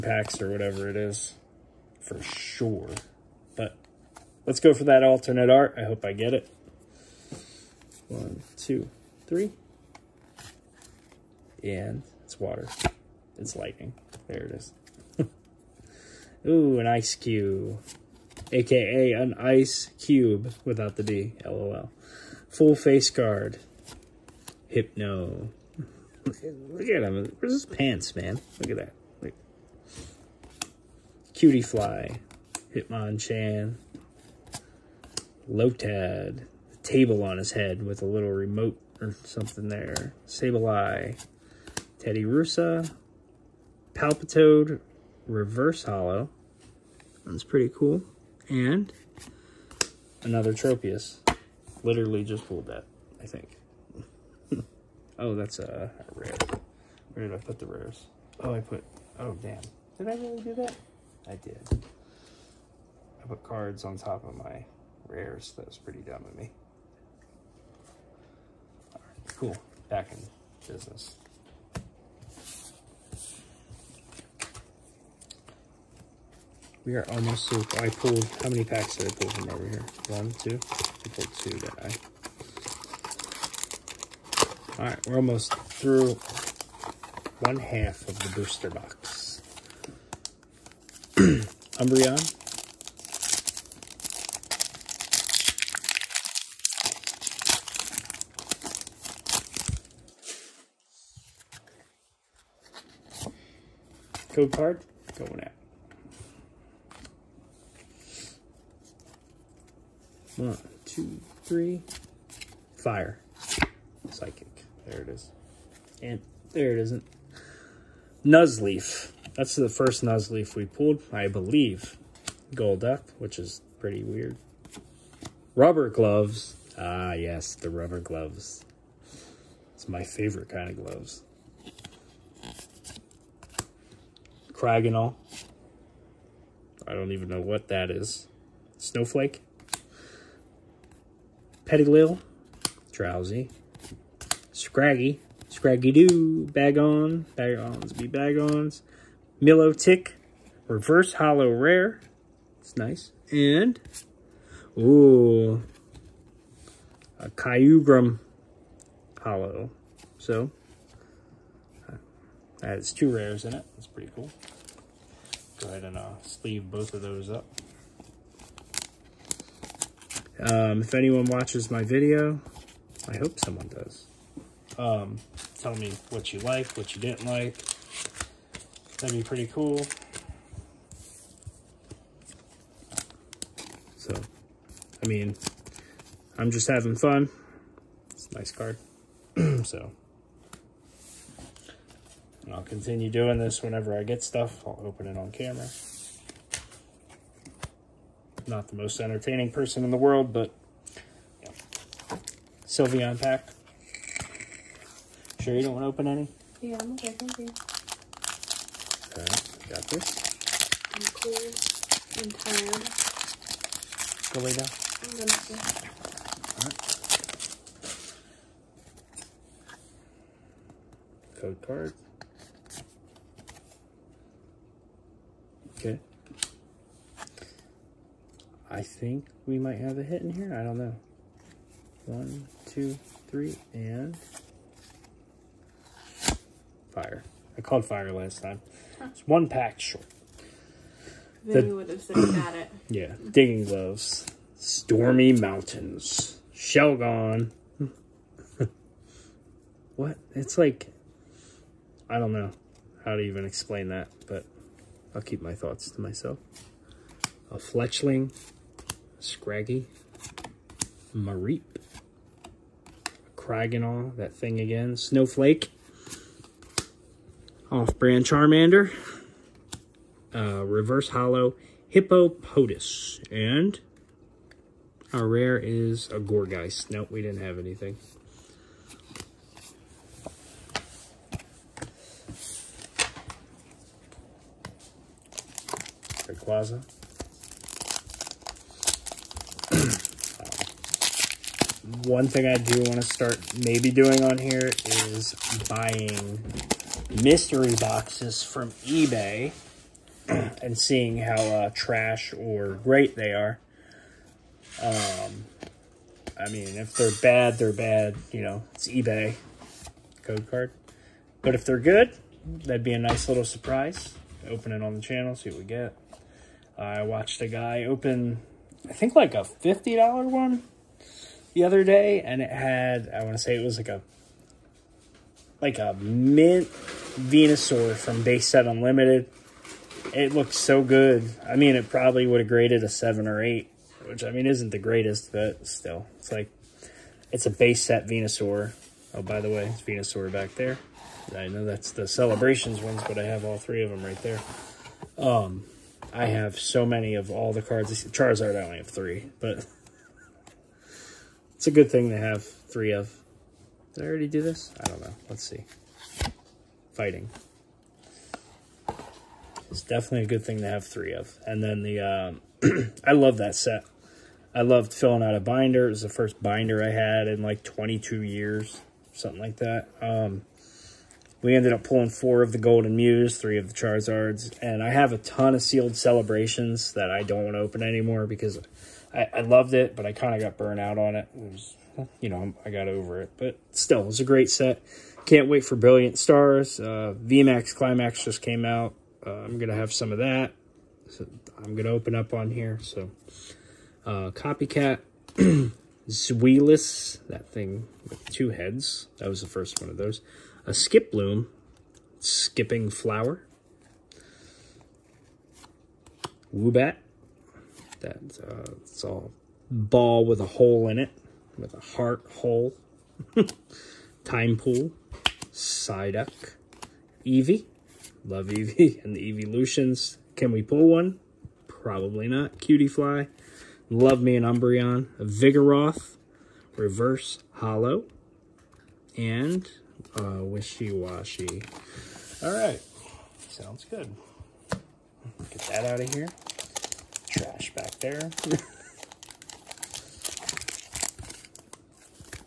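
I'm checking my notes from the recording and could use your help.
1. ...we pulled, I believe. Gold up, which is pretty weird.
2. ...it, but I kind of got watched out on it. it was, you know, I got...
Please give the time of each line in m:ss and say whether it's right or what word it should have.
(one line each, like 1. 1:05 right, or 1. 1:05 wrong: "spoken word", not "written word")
1. 2:00 right
2. 6:19 wrong: "burned", not "watched".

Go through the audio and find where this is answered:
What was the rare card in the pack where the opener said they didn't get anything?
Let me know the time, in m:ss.
4:36.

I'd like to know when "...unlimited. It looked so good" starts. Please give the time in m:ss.
5:28.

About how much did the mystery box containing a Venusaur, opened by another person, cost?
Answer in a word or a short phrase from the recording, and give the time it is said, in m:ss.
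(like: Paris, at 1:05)
$50, at 5:19.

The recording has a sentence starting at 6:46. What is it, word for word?
Woobat, that's uh, it's all ball with a hole in it, with a heart hole.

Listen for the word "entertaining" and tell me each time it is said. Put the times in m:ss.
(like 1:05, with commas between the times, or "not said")
3:19.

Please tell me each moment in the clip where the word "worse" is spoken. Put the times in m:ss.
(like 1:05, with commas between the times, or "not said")
not said.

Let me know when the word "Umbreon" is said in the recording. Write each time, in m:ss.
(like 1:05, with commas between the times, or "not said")
1:31, 7:04.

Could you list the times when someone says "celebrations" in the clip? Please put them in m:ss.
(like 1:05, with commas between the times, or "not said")
5:42, 6:15.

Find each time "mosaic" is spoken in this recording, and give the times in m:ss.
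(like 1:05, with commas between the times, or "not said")
not said.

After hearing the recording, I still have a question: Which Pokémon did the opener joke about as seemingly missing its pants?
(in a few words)
Hypno.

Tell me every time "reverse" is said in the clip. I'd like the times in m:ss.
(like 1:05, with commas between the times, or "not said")
0:45, 2:30, 4:30, 7:06.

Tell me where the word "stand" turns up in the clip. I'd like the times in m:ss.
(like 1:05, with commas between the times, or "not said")
not said.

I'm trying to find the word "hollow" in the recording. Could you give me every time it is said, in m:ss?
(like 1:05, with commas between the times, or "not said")
0:45, 2:31, 2:39, 4:31, 7:07.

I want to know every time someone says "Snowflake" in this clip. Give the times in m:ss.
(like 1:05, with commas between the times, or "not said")
2:18, 4:24.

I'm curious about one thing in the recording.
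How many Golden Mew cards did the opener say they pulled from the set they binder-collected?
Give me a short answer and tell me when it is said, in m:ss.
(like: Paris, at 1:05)
4, at 6:12.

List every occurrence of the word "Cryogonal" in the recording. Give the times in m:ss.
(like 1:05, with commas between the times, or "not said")
2:14, 4:23.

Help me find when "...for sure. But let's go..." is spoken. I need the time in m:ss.
0:01.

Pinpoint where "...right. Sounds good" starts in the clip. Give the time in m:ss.
7:12.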